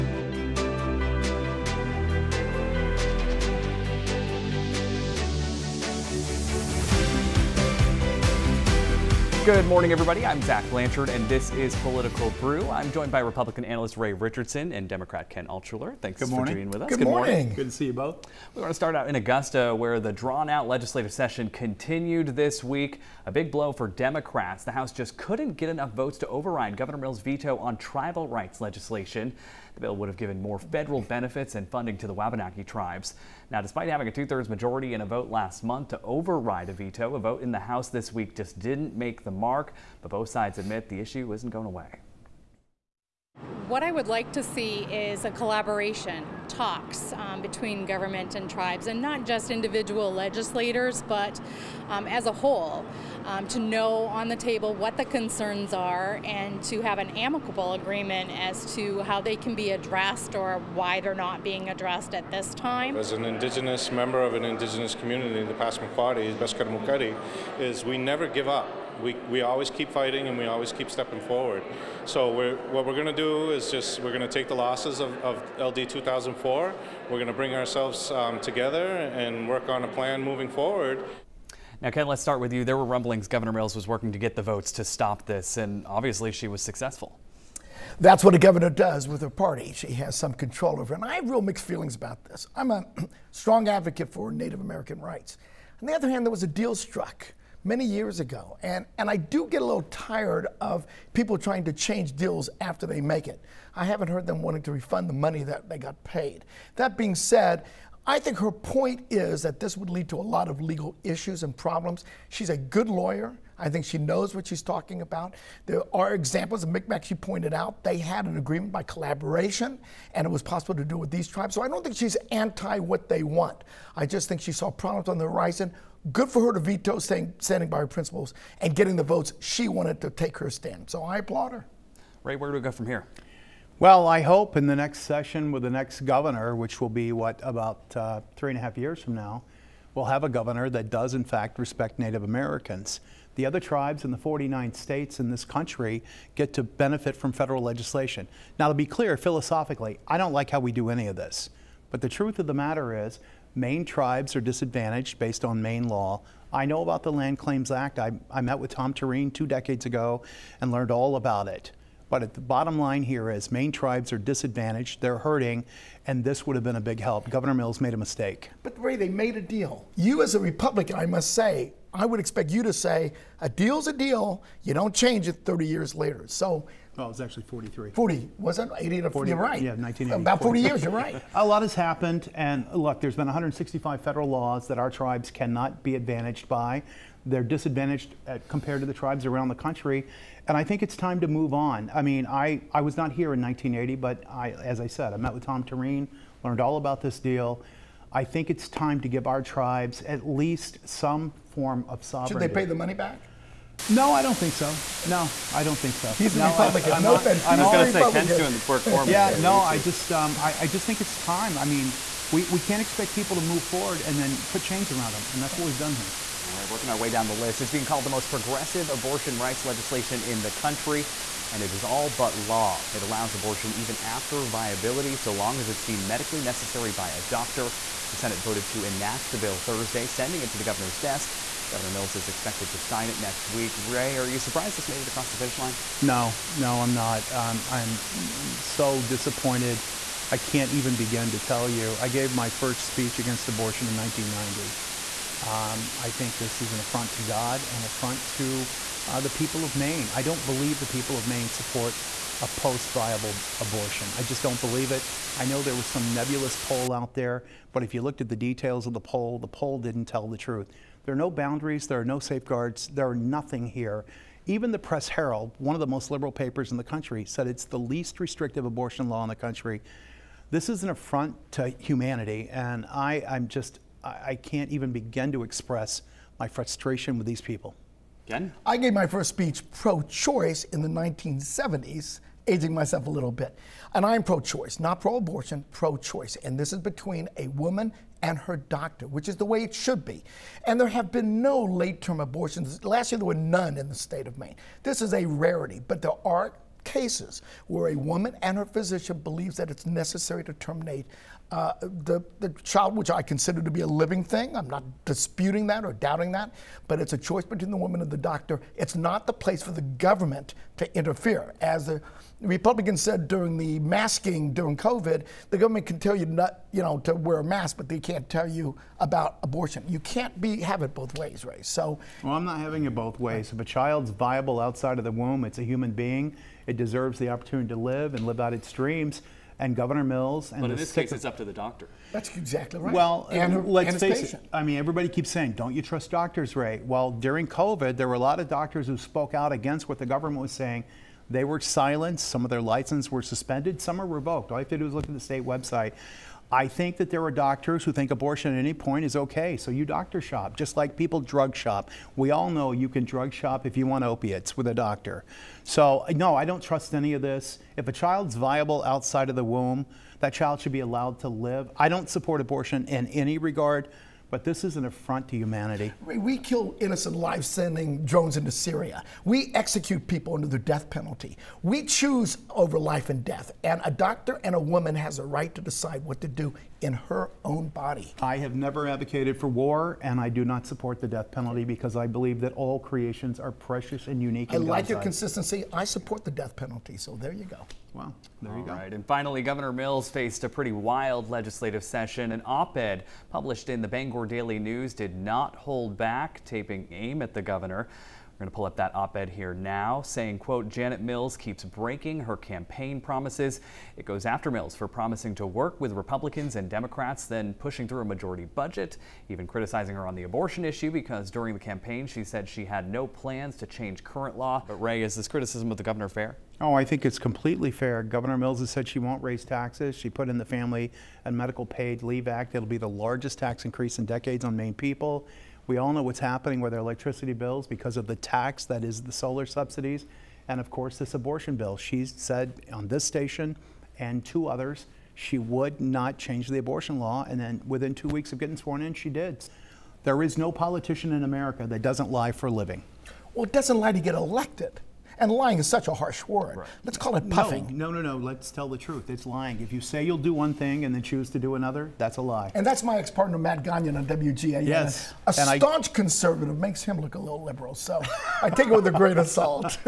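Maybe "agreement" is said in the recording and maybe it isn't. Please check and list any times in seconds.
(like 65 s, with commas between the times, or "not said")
57 s, 118 s.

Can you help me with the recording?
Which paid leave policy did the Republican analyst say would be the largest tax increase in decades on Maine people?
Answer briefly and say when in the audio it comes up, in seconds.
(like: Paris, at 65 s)
Family and Medical Paid Leave Act, at 420 s.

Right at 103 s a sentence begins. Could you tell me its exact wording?
I haven't heard them wanting to refund the money that they got paid.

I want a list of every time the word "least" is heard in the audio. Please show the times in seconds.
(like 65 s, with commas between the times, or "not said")
200 s, 267 s.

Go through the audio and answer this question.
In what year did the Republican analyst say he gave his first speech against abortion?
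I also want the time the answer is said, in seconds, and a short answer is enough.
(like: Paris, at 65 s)
1990, at 243 s.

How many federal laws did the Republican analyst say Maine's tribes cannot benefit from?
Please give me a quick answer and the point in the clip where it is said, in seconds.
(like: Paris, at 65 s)
165, at 183 s.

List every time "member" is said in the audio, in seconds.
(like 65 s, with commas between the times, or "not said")
63 s.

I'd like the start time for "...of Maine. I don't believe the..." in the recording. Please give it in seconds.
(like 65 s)
249 s.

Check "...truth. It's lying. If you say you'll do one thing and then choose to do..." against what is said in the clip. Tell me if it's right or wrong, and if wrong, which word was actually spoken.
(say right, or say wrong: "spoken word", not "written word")
right.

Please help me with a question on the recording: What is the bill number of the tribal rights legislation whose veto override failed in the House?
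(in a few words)
LD 2004.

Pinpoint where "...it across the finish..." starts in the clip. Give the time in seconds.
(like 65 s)
235 s.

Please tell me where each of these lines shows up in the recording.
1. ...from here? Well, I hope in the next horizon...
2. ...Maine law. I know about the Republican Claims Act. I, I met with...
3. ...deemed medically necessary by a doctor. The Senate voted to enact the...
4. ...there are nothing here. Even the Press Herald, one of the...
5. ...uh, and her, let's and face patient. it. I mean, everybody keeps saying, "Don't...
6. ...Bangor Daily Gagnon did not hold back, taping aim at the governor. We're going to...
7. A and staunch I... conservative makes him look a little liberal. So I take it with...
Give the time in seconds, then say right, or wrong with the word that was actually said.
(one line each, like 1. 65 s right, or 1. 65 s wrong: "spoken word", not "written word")
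1. 132 s wrong: "session", not "horizon"
2. 155 s wrong: "Land", not "Republican"
3. 225 s right
4. 262 s right
5. 333 s right
6. 393 s wrong: "News", not "Gagnon"
7. 455 s right.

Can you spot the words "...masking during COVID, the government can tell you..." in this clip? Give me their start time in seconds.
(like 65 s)
313 s.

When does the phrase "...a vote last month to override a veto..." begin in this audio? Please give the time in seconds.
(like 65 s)
35 s.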